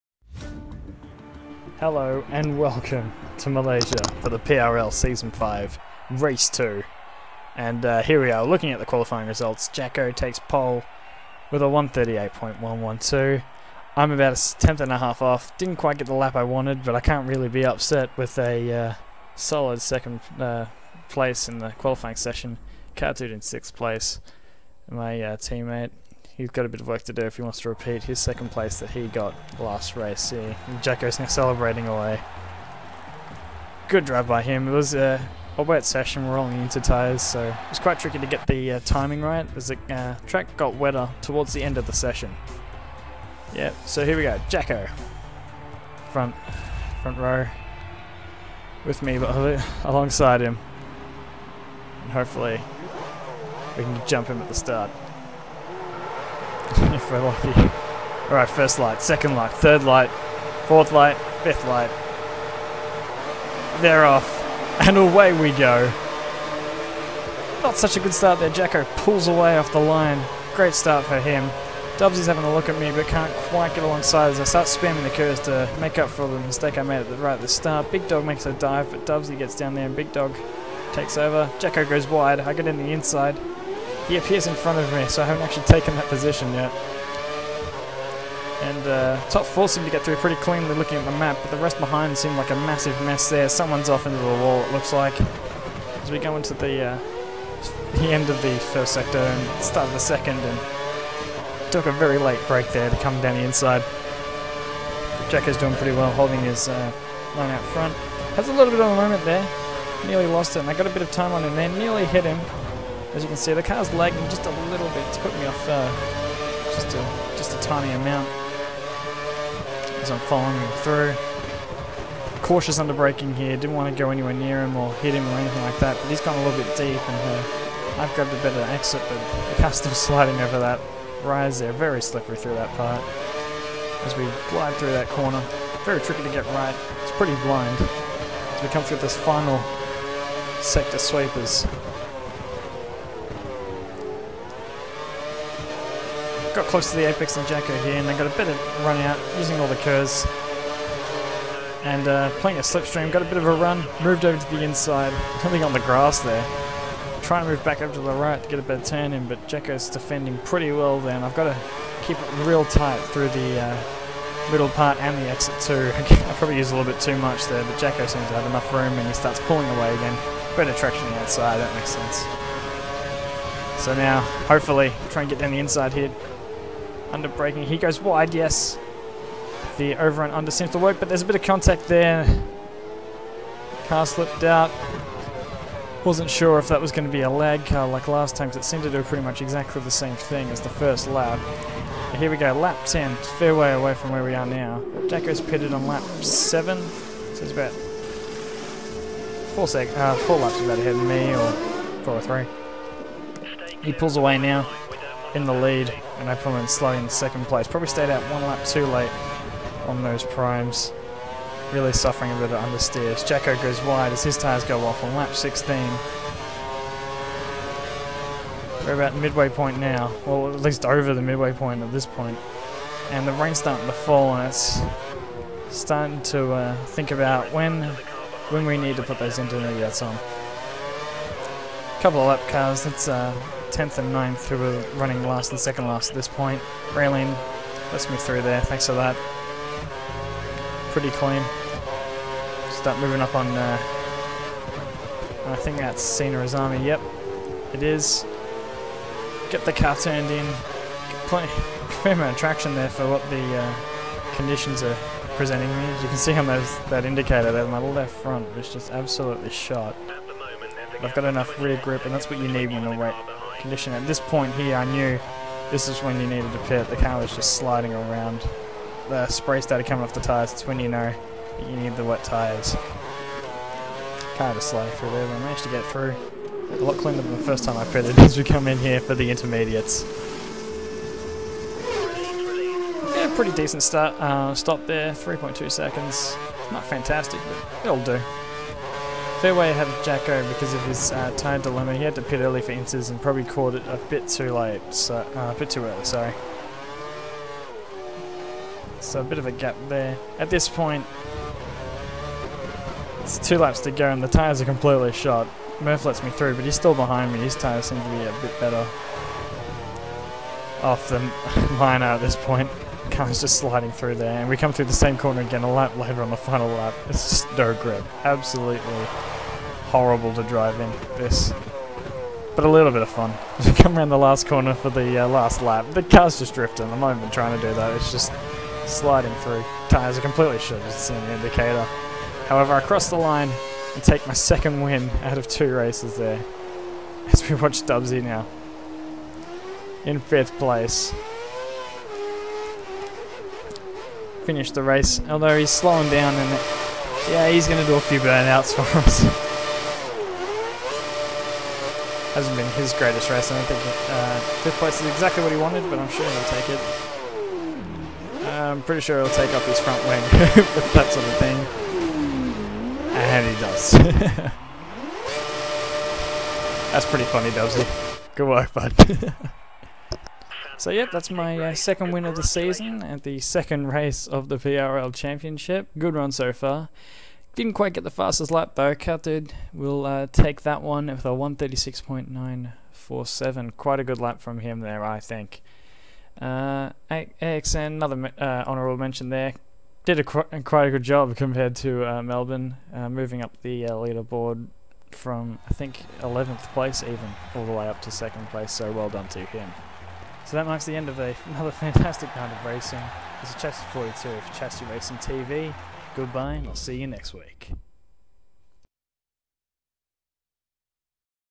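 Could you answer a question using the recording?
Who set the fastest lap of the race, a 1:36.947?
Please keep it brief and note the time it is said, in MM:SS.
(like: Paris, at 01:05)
Cat, at 06:18.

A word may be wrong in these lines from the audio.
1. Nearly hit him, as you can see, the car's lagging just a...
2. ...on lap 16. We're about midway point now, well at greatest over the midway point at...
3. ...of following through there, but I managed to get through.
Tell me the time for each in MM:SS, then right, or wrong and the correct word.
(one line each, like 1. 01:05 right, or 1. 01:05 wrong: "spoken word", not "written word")
1. 01:51 right
2. 03:35 wrong: "least", not "greatest"
3. 04:34 wrong: "sliding", not "following".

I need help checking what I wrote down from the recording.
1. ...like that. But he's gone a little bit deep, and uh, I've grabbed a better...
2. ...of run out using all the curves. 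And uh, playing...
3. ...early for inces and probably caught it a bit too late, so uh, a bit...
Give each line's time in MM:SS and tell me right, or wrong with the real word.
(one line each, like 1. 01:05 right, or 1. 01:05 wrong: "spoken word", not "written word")
1. 02:05 right
2. 02:28 right
3. 04:52 right.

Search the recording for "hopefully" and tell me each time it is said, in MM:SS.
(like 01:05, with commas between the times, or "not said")
00:52, 02:54.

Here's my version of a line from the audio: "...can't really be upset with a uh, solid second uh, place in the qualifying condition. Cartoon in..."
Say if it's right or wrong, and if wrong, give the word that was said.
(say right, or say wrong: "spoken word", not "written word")
wrong: "session", not "condition".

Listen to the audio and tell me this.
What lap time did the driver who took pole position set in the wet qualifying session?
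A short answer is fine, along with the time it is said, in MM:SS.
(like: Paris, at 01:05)
1:38.112, at 00:11.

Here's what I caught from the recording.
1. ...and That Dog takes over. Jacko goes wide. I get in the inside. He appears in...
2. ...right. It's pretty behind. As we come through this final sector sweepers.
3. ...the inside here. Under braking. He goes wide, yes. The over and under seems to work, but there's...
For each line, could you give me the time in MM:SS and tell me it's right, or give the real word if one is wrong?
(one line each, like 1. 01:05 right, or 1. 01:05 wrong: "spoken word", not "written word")
1. 01:19 wrong: "Big", not "That"
2. 02:16 wrong: "blind", not "behind"
3. 02:55 right.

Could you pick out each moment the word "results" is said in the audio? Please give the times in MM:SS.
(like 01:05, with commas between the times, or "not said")
00:09.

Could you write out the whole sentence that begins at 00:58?
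Alright, first light, second light, third light, fourth light, fifth light.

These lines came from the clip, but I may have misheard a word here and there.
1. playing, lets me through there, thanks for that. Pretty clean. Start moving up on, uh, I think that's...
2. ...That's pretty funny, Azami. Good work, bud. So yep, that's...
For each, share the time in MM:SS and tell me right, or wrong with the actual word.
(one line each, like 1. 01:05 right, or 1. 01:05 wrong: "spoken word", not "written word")
1. 03:56 wrong: "railing", not "playing"
2. 06:06 wrong: "Dubsy", not "Azami".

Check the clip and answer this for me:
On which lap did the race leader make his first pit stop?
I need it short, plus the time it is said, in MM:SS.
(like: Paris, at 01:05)
Lap 7, at 03:15.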